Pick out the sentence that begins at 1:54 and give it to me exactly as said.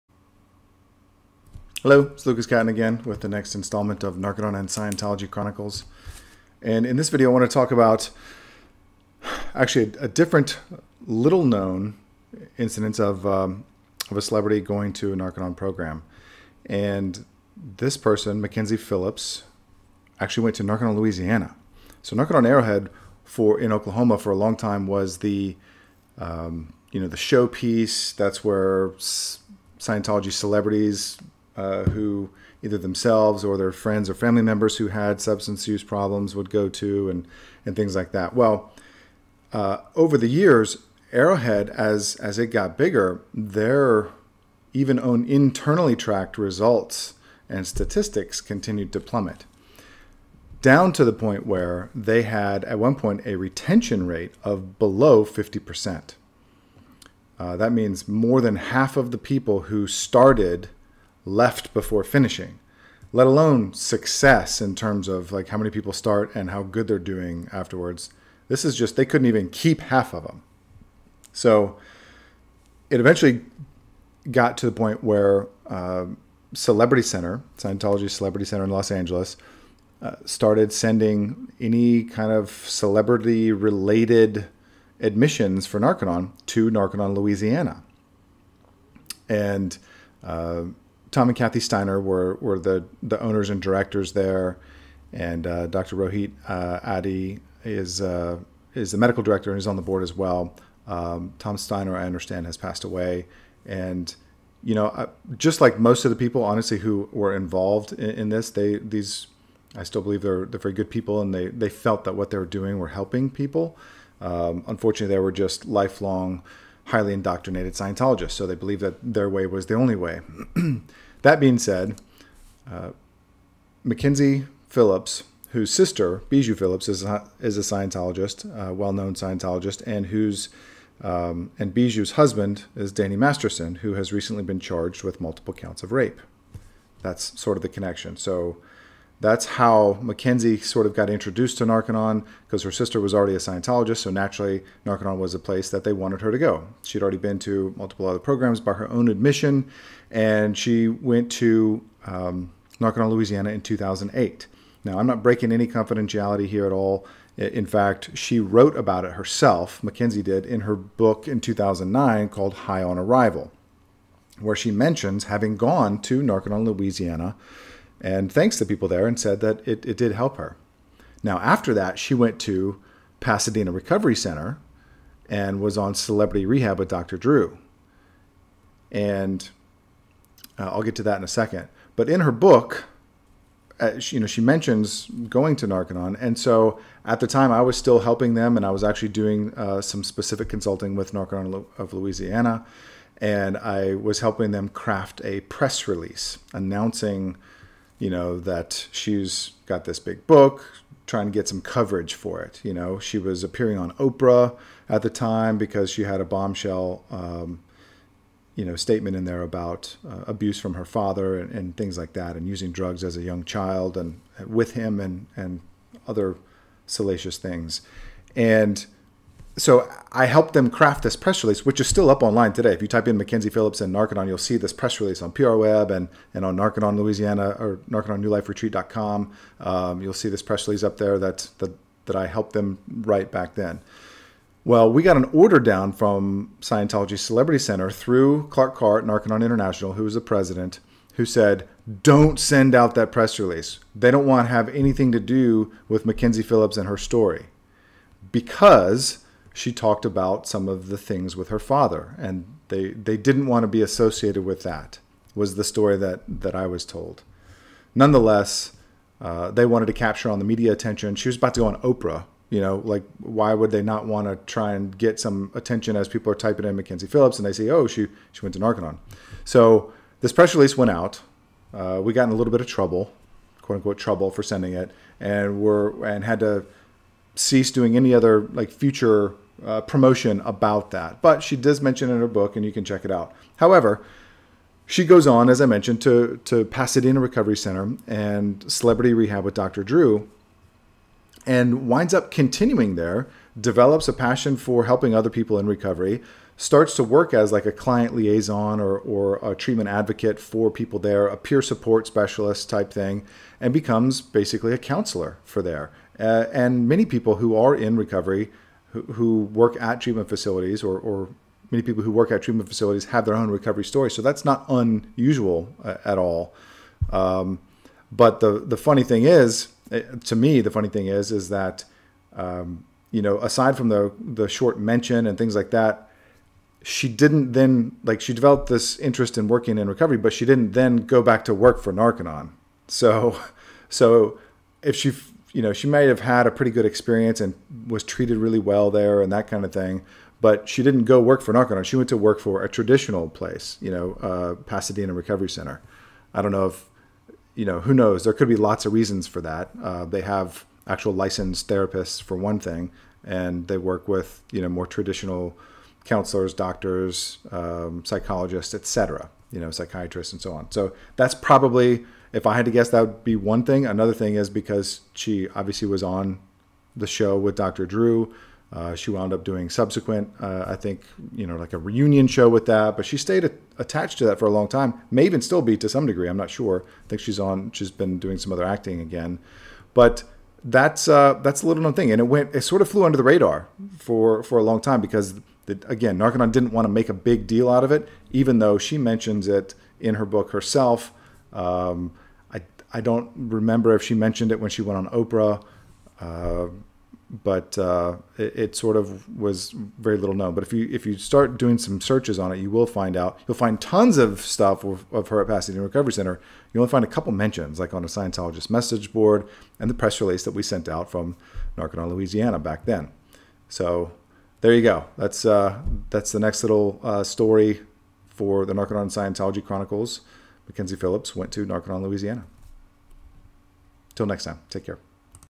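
Um, unfortunately, they were just lifelong highly indoctrinated Scientologists, so they believe that their way was the only way.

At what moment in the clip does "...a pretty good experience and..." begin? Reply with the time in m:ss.
5:36.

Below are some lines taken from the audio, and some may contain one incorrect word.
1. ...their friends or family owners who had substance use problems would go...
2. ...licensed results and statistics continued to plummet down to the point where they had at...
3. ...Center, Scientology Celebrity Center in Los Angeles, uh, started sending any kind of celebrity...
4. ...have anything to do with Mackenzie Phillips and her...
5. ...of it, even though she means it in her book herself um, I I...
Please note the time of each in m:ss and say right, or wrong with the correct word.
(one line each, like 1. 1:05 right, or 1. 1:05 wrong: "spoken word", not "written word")
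1. 0:33 wrong: "members", not "owners"
2. 0:45 wrong: "tracked", not "licensed"
3. 1:17 right
4. 4:04 right
5. 6:27 wrong: "mentions", not "means".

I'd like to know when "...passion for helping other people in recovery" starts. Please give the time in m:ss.
4:54.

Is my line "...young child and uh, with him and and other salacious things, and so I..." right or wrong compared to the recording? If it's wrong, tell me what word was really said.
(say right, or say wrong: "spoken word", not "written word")
right.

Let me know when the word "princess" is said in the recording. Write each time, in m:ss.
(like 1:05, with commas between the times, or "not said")
not said.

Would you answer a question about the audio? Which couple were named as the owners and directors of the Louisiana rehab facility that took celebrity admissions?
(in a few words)
Tom and Kathy Steiner.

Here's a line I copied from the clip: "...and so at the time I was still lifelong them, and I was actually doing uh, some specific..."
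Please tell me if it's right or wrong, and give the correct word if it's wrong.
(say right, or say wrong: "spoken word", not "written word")
wrong: "helping", not "lifelong".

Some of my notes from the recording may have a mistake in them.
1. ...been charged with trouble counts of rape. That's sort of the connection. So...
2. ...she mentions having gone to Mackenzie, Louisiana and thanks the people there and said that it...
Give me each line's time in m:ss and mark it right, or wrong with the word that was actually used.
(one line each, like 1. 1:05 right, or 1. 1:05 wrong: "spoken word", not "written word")
1. 2:14 wrong: "multiple", not "trouble"
2. 2:44 wrong: "Narconon", not "Mackenzie".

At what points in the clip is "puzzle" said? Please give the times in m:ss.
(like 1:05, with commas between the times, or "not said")
not said.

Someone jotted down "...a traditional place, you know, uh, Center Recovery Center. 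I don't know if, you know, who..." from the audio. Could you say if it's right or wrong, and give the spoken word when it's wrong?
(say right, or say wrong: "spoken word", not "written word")
wrong: "Pasadena", not "Center".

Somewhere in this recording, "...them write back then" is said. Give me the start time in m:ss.
3:52.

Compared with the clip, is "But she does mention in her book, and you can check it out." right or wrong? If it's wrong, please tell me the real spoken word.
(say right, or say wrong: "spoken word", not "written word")
right.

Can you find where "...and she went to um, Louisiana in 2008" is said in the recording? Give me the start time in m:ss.
2:30.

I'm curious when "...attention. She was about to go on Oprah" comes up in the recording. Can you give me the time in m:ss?
4:20.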